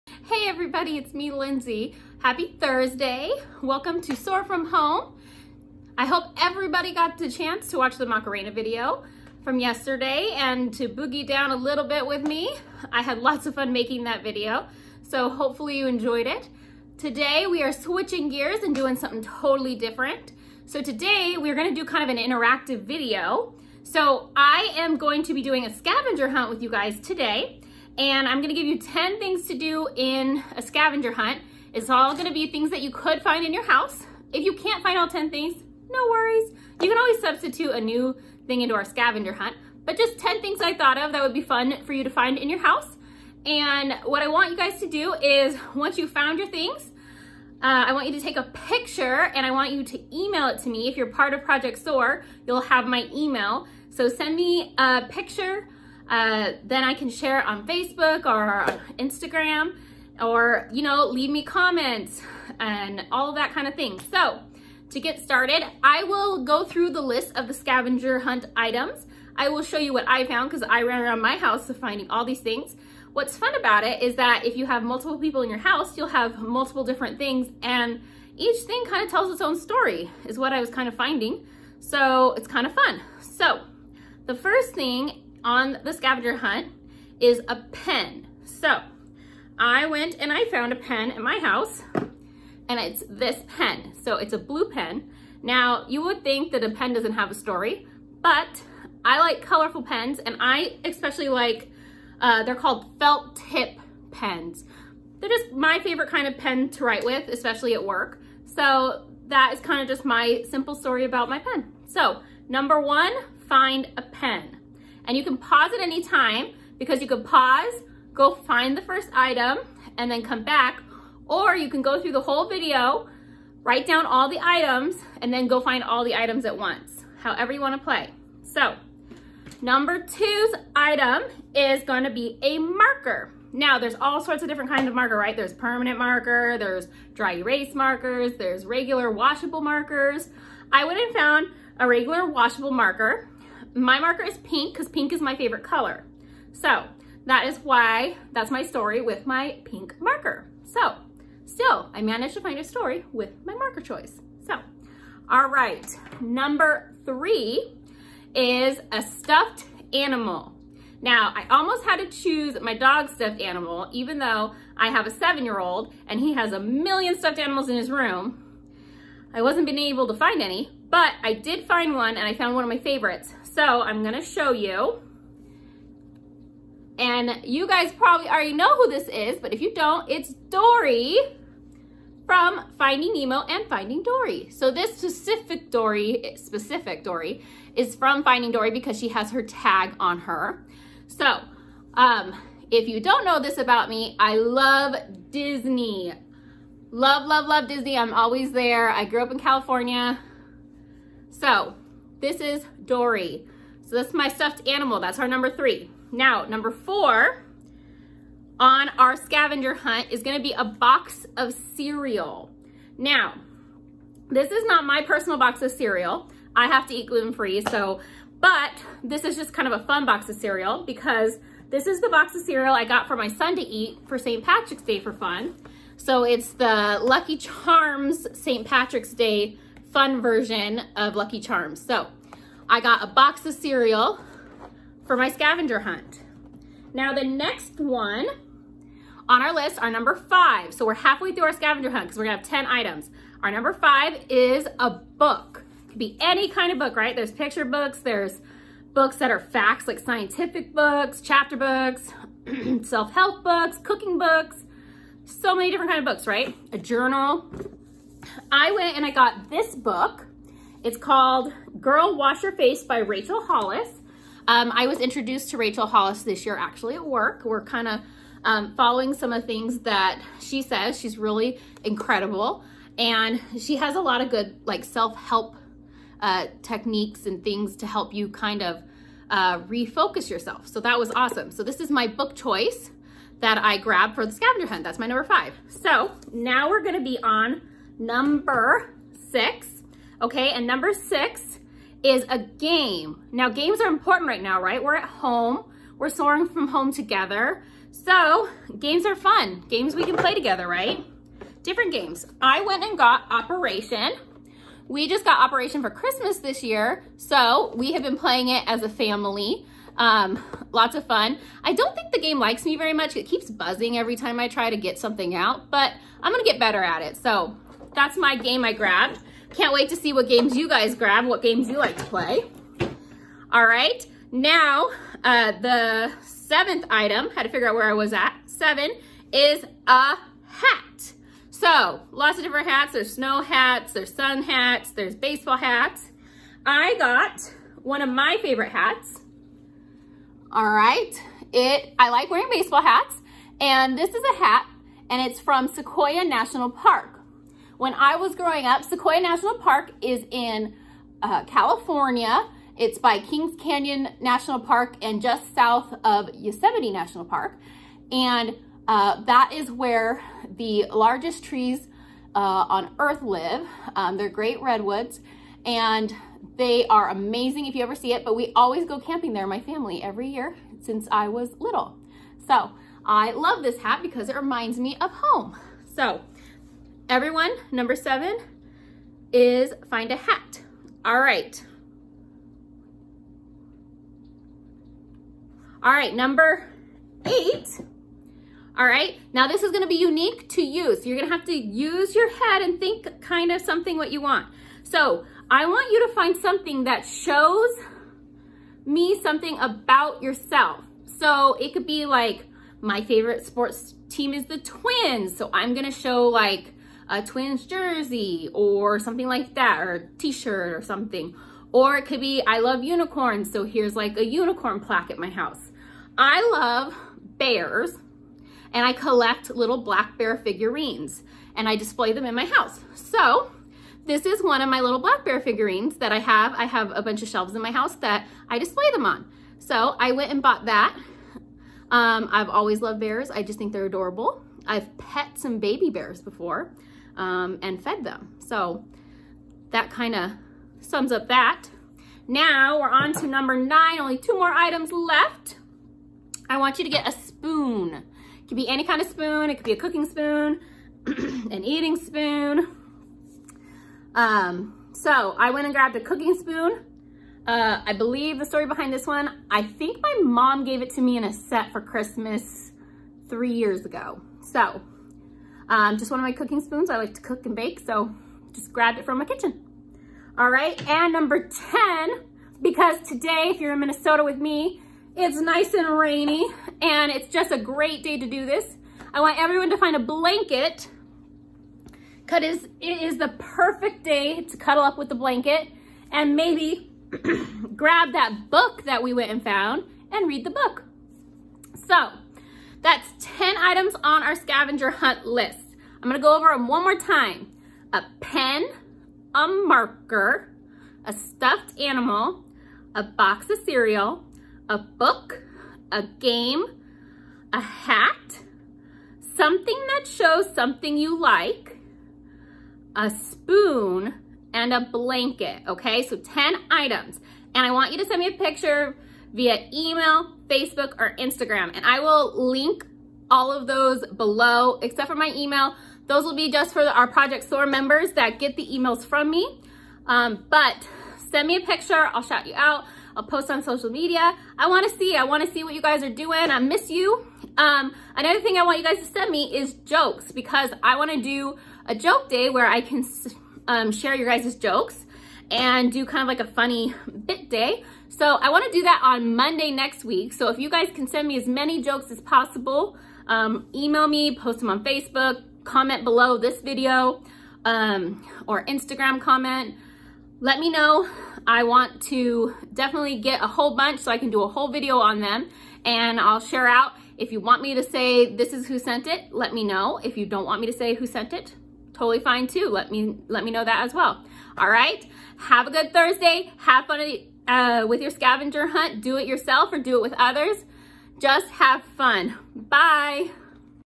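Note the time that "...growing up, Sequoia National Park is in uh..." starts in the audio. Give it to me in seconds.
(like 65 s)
348 s.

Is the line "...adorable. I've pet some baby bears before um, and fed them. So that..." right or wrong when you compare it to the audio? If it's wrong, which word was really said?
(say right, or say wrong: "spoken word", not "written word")
right.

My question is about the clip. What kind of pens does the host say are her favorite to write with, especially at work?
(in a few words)
felt tip pens.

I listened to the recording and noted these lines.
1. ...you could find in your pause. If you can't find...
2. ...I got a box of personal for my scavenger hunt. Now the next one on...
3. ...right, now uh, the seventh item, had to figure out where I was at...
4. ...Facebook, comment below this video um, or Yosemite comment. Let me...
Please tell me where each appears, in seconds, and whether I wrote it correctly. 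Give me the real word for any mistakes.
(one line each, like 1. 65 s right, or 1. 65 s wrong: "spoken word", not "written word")
1. 32 s wrong: "house", not "pause"
2. 232 s wrong: "cereal", not "personal"
3. 323 s right
4. 554 s wrong: "Instagram", not "Yosemite".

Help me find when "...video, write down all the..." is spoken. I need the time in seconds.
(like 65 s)
122 s.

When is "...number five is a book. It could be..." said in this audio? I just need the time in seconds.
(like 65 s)
243 s.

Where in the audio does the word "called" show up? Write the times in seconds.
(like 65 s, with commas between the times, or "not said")
102 s, 260 s.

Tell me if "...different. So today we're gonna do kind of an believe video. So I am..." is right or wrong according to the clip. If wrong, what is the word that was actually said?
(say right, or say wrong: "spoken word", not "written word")
wrong: "interactive", not "believe".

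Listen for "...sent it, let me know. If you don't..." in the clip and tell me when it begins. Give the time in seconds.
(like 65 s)
568 s.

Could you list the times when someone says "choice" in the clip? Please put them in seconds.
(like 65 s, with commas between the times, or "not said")
153 s, 282 s.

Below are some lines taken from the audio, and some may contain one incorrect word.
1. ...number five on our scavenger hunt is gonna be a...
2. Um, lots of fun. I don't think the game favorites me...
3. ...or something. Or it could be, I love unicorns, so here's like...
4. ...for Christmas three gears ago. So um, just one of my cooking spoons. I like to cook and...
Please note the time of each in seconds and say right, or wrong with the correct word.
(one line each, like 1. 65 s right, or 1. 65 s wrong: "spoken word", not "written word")
1. 206 s wrong: "four", not "five"
2. 309 s wrong: "likes", not "favorites"
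3. 410 s right
4. 461 s wrong: "years", not "gears".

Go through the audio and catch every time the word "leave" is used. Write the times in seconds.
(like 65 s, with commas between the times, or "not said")
61 s.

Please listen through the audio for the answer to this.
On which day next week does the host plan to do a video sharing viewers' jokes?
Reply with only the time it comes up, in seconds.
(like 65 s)
549 s.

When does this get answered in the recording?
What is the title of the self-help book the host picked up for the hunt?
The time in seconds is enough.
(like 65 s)
261 s.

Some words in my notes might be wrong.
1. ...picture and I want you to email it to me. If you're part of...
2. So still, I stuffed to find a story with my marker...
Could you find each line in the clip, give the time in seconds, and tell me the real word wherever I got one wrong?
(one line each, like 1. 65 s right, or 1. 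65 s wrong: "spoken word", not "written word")
1. 48 s right
2. 150 s wrong: "managed", not "stuffed".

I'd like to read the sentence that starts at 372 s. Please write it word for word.
So I love this hat because it reminds me of home.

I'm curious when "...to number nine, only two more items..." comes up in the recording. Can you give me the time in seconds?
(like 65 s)
443 s.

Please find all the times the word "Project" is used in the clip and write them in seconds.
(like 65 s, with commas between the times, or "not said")
51 s, 527 s.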